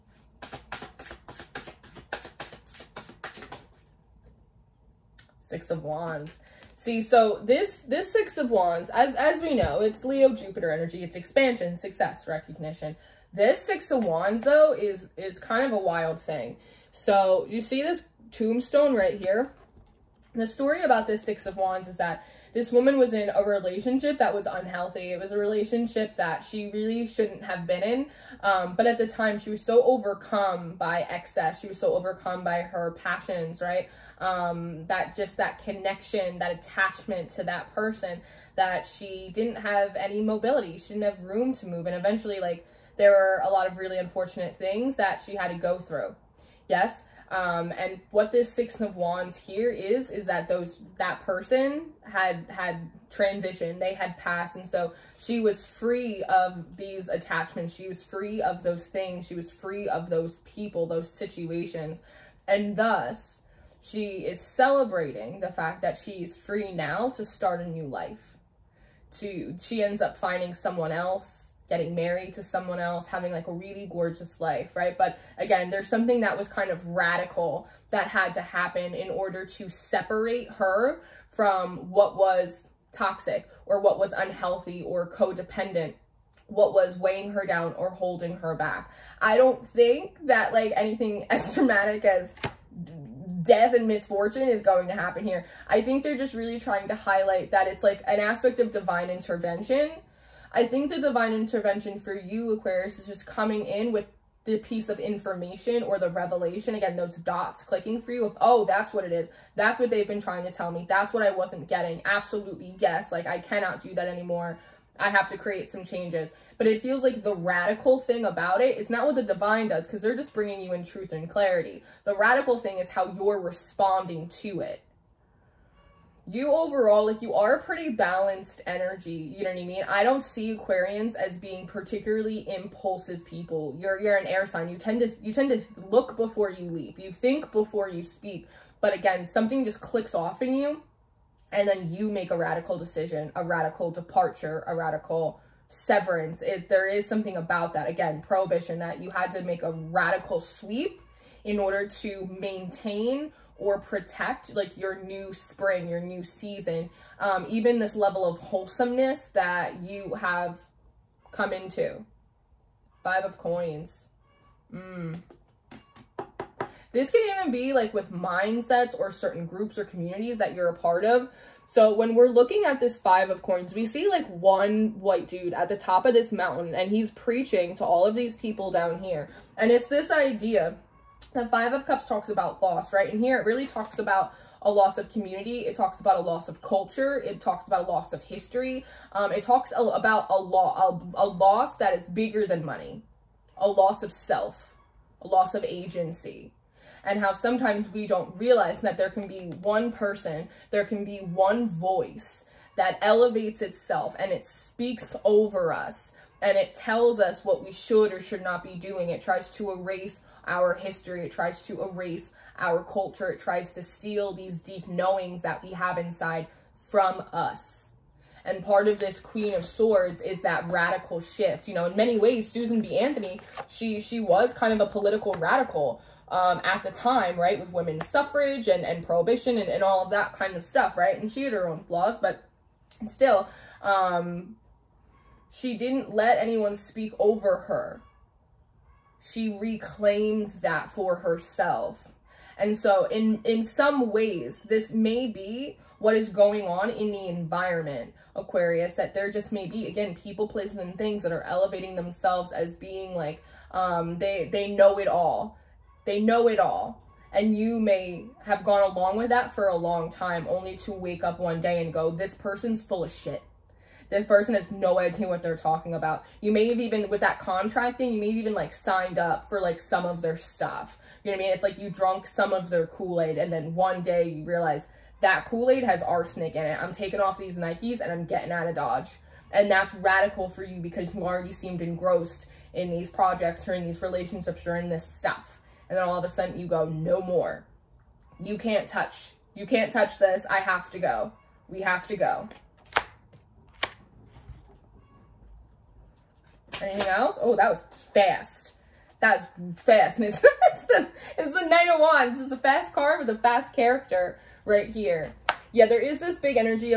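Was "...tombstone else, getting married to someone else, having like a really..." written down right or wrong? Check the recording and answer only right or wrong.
wrong.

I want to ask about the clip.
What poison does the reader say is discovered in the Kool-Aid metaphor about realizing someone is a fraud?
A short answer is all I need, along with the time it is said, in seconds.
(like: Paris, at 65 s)
Arsenic, at 276 s.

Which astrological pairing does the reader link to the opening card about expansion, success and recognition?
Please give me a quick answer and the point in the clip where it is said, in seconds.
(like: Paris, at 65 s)
Leo Jupiter, at 10 s.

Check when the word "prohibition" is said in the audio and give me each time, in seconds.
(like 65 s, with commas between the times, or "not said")
148 s, 229 s.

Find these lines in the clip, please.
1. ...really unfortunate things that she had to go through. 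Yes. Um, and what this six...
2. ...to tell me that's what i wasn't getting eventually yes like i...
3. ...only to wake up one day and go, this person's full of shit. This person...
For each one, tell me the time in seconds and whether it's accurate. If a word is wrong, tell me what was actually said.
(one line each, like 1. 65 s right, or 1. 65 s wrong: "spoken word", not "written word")
1. 43 s right
2. 110 s wrong: "absolutely", not "eventually"
3. 260 s right.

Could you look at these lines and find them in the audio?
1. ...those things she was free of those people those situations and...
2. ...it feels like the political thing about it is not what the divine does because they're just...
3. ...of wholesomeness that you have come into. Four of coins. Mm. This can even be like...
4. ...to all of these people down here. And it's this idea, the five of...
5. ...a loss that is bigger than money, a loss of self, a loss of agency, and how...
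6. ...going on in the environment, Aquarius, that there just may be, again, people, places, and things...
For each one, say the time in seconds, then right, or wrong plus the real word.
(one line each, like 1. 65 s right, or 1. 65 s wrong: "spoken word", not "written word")
1. 58 s right
2. 116 s wrong: "radical", not "political"
3. 158 s wrong: "Five", not "Four"
4. 177 s right
5. 191 s right
6. 246 s right.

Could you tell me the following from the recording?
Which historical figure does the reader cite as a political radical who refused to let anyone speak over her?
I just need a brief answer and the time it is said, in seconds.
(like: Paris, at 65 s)
Susan B. Anthony, at 222 s.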